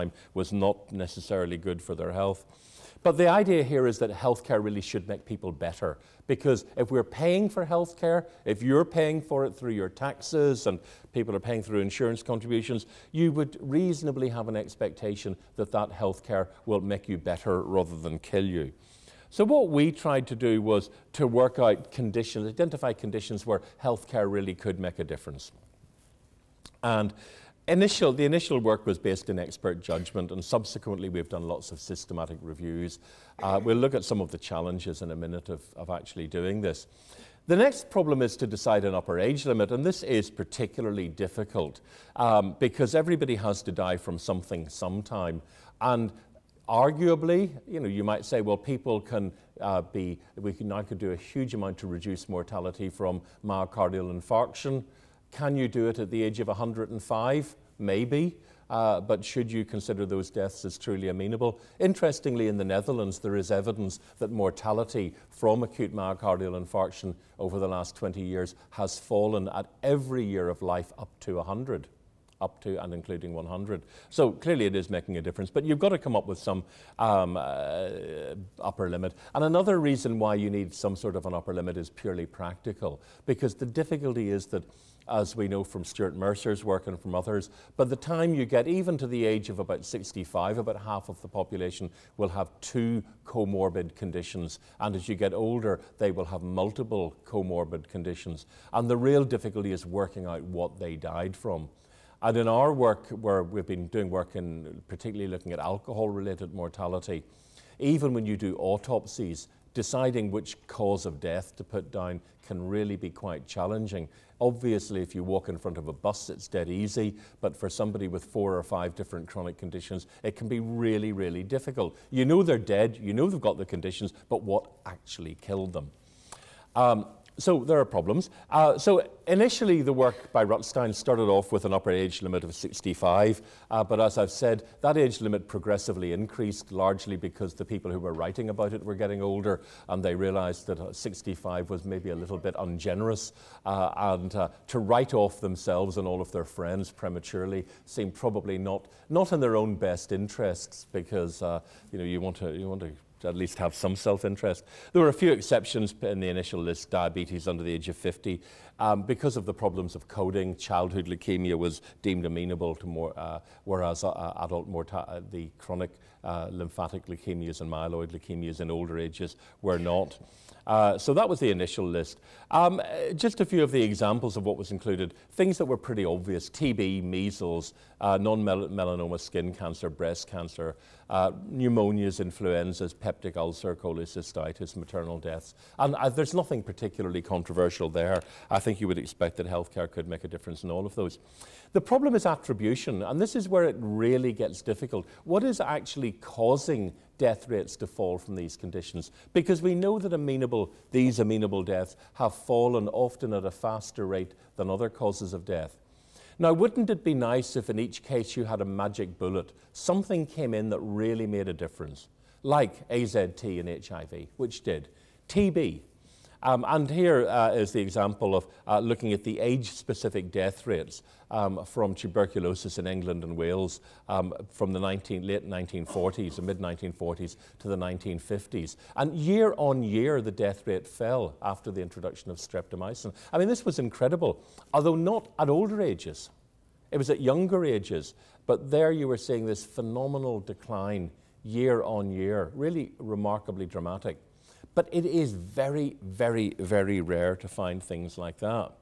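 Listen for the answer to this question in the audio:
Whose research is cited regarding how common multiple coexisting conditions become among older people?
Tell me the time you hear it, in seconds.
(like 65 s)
85 s.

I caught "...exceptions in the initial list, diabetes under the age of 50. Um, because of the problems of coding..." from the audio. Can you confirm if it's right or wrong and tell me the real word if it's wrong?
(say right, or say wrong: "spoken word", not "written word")
right.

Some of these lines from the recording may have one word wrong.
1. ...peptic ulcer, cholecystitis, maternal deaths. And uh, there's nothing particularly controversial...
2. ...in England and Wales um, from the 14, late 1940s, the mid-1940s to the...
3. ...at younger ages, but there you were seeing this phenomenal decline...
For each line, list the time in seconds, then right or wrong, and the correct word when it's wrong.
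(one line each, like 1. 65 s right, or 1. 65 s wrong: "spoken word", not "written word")
1. 182 s right
2. 222 s wrong: "19", not "14"
3. 237 s right.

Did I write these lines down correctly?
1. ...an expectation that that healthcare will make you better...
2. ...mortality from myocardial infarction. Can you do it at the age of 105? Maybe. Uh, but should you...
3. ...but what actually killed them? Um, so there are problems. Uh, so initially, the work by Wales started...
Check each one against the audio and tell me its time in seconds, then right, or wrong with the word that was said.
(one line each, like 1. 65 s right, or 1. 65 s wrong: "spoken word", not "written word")
1. 14 s right
2. 52 s right
3. 124 s wrong: "Rutstein", not "Wales".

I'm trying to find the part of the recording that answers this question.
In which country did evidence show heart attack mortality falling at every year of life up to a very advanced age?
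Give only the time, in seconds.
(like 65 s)
62 s.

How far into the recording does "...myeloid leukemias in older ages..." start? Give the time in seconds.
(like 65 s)
167 s.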